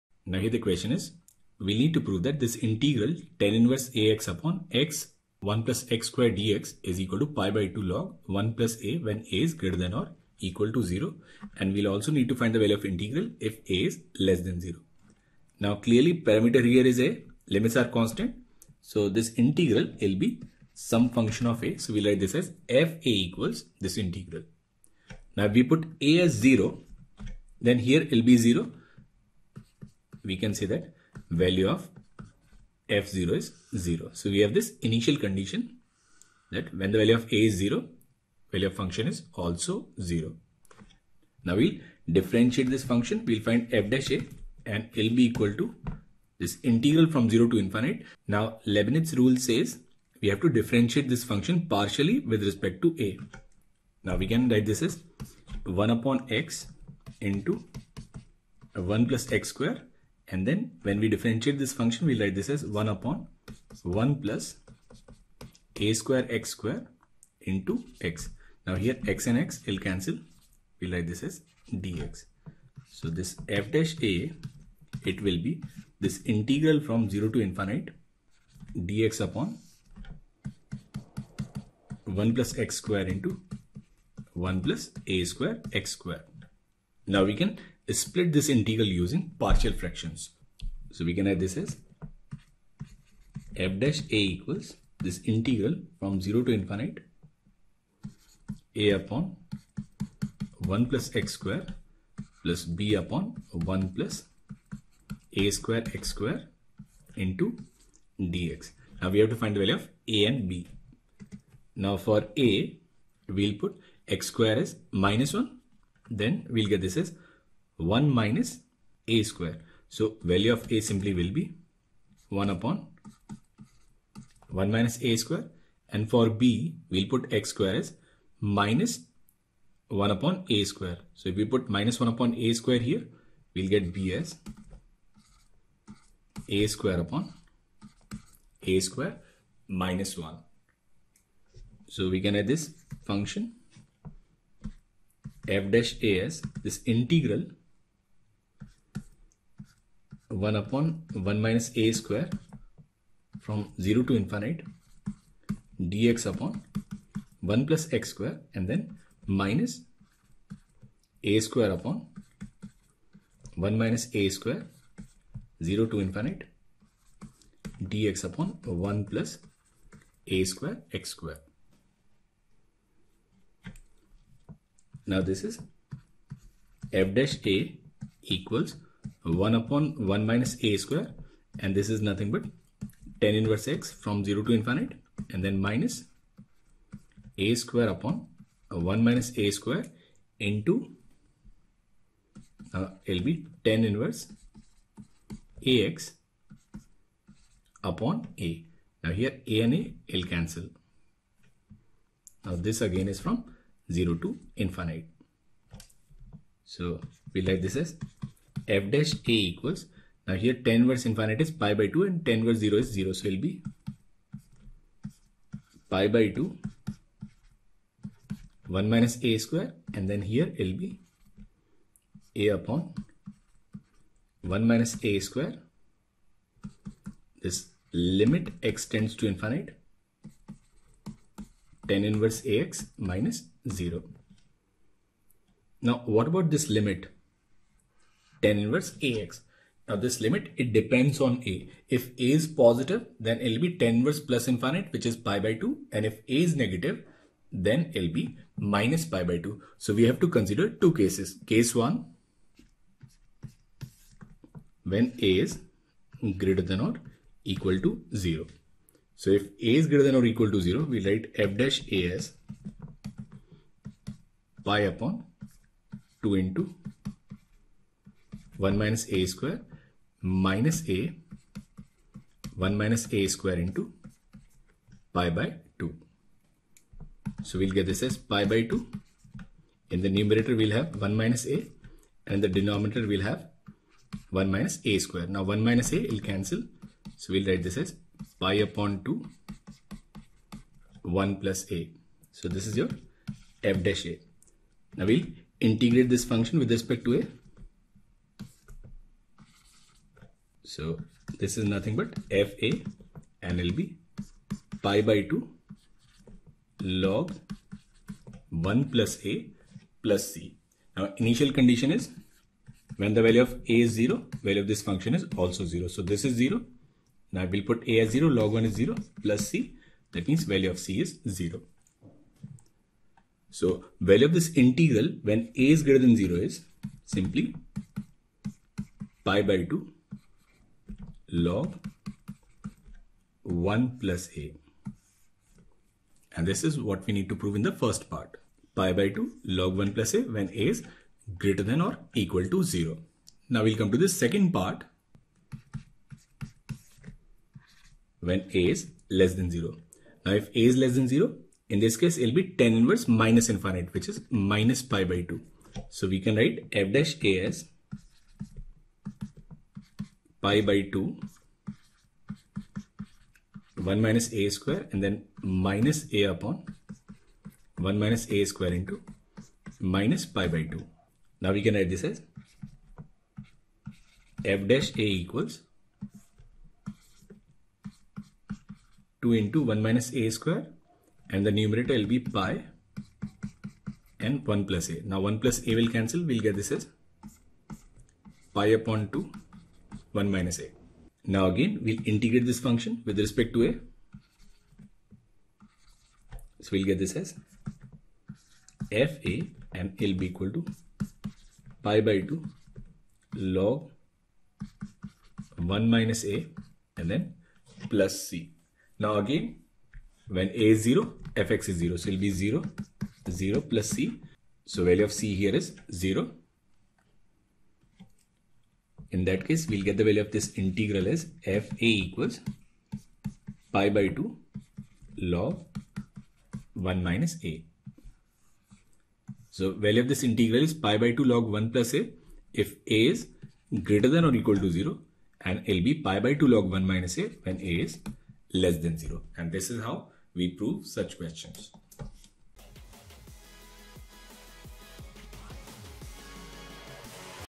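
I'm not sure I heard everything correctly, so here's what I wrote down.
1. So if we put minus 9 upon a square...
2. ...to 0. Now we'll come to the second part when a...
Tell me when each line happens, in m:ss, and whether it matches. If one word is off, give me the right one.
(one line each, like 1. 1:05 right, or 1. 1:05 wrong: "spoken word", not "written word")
1. 2:11 wrong: "1", not "9"
2. 5:42 right.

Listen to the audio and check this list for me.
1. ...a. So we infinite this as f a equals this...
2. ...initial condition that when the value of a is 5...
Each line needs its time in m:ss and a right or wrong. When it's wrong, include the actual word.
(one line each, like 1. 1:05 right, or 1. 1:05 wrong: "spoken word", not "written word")
1. 0:21 wrong: "write", not "infinite"
2. 0:34 wrong: "0", not "5".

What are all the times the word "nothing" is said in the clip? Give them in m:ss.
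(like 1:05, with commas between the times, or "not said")
3:02, 5:01.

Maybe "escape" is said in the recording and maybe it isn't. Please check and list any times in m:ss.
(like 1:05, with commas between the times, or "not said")
not said.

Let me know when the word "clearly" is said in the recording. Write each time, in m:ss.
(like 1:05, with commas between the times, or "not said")
0:15.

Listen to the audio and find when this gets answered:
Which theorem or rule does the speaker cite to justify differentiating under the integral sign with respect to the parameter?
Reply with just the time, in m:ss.
0:48.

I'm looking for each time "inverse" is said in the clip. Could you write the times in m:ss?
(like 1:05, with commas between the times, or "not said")
0:03, 3:03, 3:13, 3:52, 3:58, 4:03, 5:52.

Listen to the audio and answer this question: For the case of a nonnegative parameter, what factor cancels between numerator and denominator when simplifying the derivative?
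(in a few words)
1 - a.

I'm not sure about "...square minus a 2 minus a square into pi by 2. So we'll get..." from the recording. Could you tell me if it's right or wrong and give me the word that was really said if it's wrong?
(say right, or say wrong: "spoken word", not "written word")
wrong: "1", not "2".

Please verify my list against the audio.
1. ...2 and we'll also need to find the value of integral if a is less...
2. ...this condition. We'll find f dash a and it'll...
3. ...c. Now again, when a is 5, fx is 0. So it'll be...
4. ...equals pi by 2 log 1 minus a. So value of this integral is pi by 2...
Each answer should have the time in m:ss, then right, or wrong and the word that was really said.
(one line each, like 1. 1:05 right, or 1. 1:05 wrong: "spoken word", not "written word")
1. 0:10 wrong: "0", not "2"
2. 0:42 wrong: "function", not "condition"
3. 6:48 wrong: "0", not "5"
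4. 7:02 right.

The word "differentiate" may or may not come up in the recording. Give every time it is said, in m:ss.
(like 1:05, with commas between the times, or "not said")
0:42, 0:50, 1:01.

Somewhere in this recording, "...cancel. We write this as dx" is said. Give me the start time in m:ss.
1:09.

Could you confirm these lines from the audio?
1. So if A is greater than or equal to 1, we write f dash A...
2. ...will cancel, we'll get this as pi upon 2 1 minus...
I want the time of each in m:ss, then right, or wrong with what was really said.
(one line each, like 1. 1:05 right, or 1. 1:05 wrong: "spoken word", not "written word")
1. 4:19 wrong: "0", not "1"
2. 6:25 right.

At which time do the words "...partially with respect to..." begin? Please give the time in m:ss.
0:51.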